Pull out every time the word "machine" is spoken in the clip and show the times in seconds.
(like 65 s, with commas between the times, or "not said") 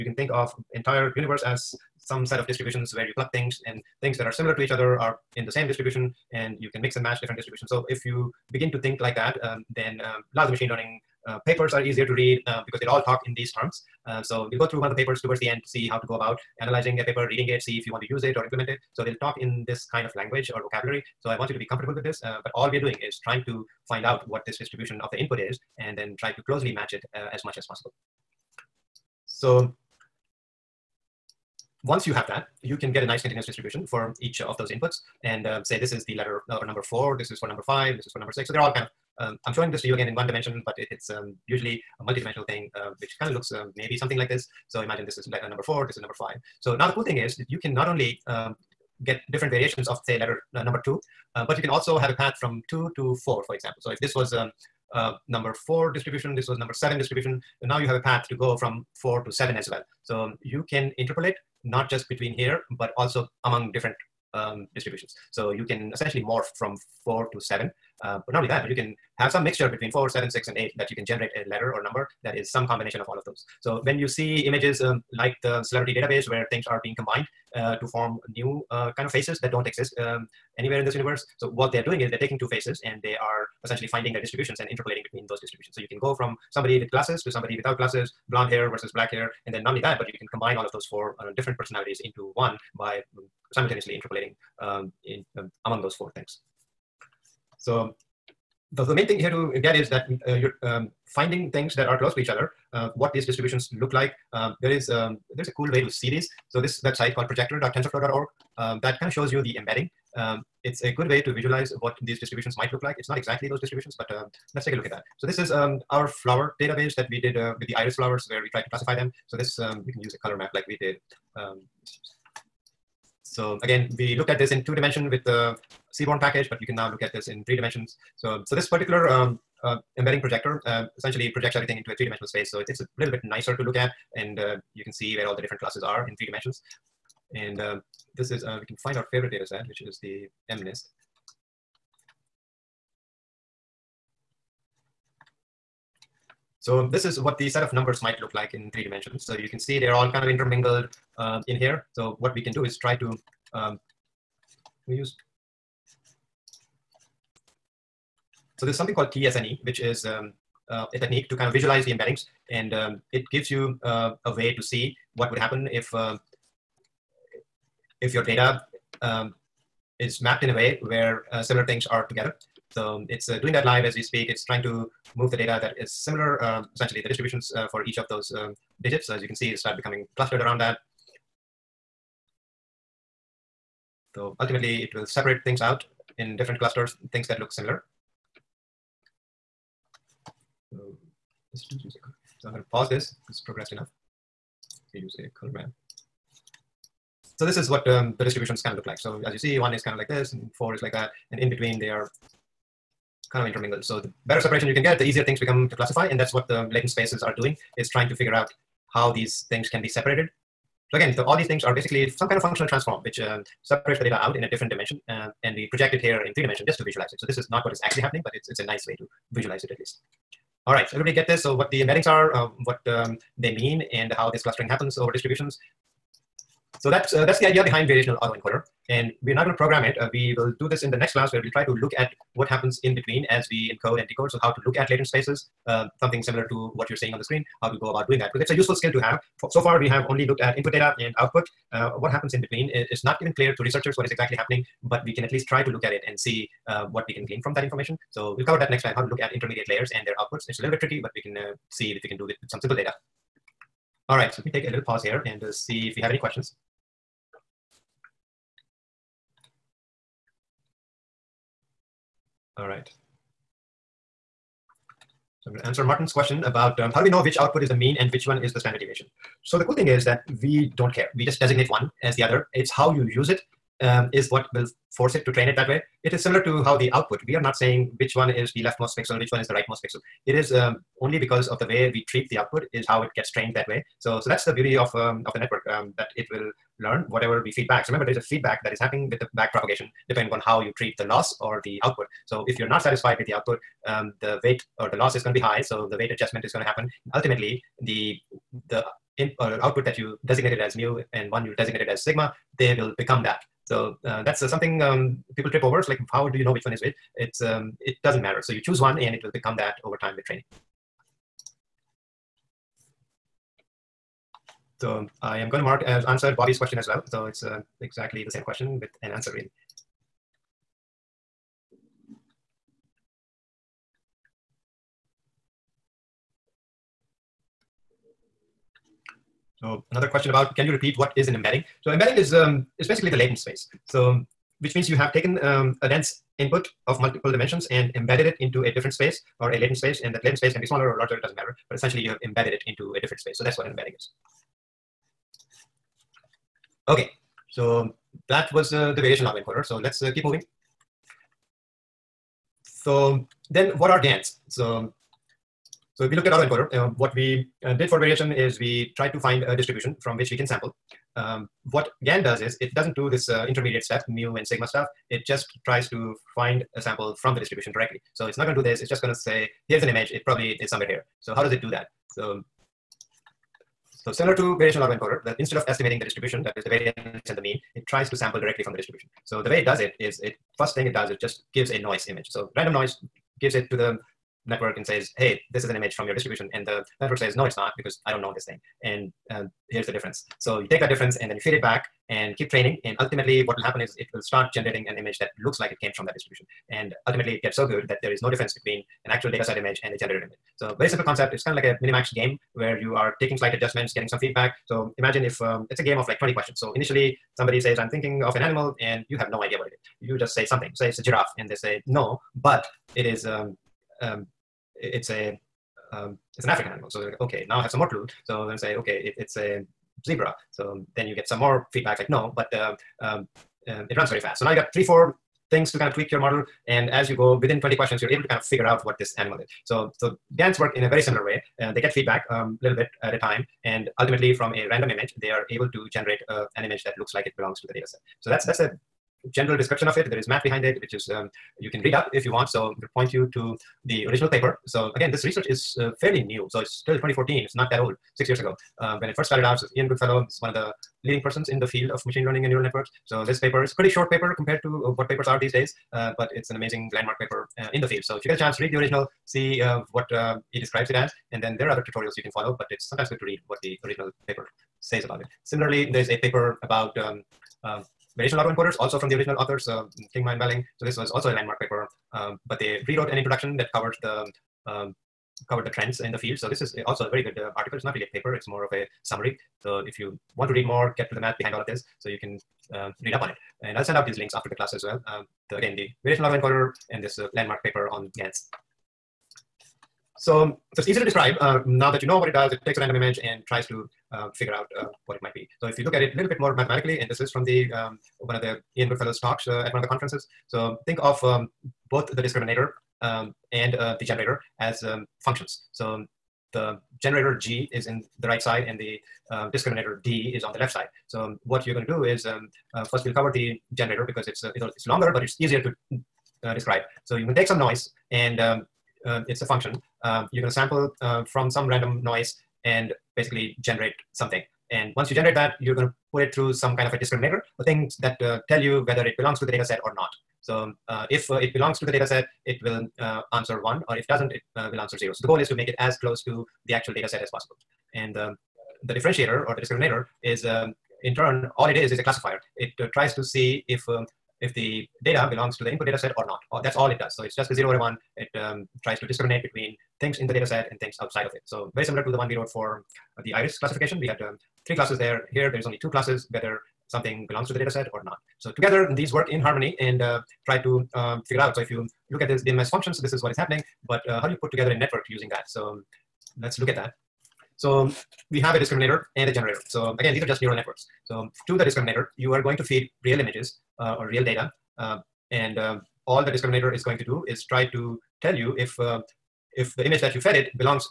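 10 s, 452 s.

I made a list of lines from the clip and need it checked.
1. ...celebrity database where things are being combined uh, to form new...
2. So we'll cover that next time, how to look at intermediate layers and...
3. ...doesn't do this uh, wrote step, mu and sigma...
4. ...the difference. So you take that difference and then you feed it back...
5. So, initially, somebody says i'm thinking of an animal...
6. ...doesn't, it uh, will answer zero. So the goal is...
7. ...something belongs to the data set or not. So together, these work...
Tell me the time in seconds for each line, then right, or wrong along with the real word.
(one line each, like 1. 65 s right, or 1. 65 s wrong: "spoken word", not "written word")
1. 75 s right
2. 248 s right
3. 362 s wrong: "intermediate", not "wrote"
4. 389 s right
5. 406 s right
6. 534 s right
7. 556 s right.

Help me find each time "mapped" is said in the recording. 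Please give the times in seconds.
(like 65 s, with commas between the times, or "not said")
170 s.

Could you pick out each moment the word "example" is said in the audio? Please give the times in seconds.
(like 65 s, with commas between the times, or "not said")
53 s.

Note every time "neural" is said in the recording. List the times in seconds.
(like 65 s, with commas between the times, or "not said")
452 s, 570 s.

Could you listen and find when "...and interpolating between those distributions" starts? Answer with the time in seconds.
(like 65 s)
84 s.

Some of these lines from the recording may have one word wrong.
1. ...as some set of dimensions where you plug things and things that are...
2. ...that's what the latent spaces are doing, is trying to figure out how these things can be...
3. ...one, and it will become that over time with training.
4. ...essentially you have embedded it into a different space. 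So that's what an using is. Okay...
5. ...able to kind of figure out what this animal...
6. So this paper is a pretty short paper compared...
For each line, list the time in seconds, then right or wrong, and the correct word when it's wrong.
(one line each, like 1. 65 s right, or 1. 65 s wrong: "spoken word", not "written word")
1. 1 s wrong: "distributions", not "dimensions"
2. 206 s right
3. 308 s right
4. 341 s wrong: "embedding", not "using"
5. 428 s right
6. 453 s right.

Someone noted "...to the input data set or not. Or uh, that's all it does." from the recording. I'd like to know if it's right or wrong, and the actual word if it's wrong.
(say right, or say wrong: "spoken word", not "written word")
right.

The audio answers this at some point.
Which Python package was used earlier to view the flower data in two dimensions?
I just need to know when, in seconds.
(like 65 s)
125 s.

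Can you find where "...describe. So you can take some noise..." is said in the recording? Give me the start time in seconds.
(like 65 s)
516 s.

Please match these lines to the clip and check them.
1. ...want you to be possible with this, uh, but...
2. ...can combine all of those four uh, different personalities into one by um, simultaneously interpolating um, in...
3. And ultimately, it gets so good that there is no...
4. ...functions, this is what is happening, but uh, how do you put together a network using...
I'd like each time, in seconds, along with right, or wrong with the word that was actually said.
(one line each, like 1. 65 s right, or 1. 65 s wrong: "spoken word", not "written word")
1. 21 s wrong: "comfortable", not "possible"
2. 90 s right
3. 396 s right
4. 562 s right.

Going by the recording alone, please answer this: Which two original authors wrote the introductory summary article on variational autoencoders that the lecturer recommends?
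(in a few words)
Kingma and Welling.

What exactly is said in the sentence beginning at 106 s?
So this website called projector.tensorflow.org um, that kind of shows you the embedding.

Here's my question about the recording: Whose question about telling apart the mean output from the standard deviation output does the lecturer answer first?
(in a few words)
Martin.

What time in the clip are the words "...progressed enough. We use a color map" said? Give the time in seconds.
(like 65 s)
193 s.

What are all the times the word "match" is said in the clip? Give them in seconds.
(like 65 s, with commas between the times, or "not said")
7 s, 26 s.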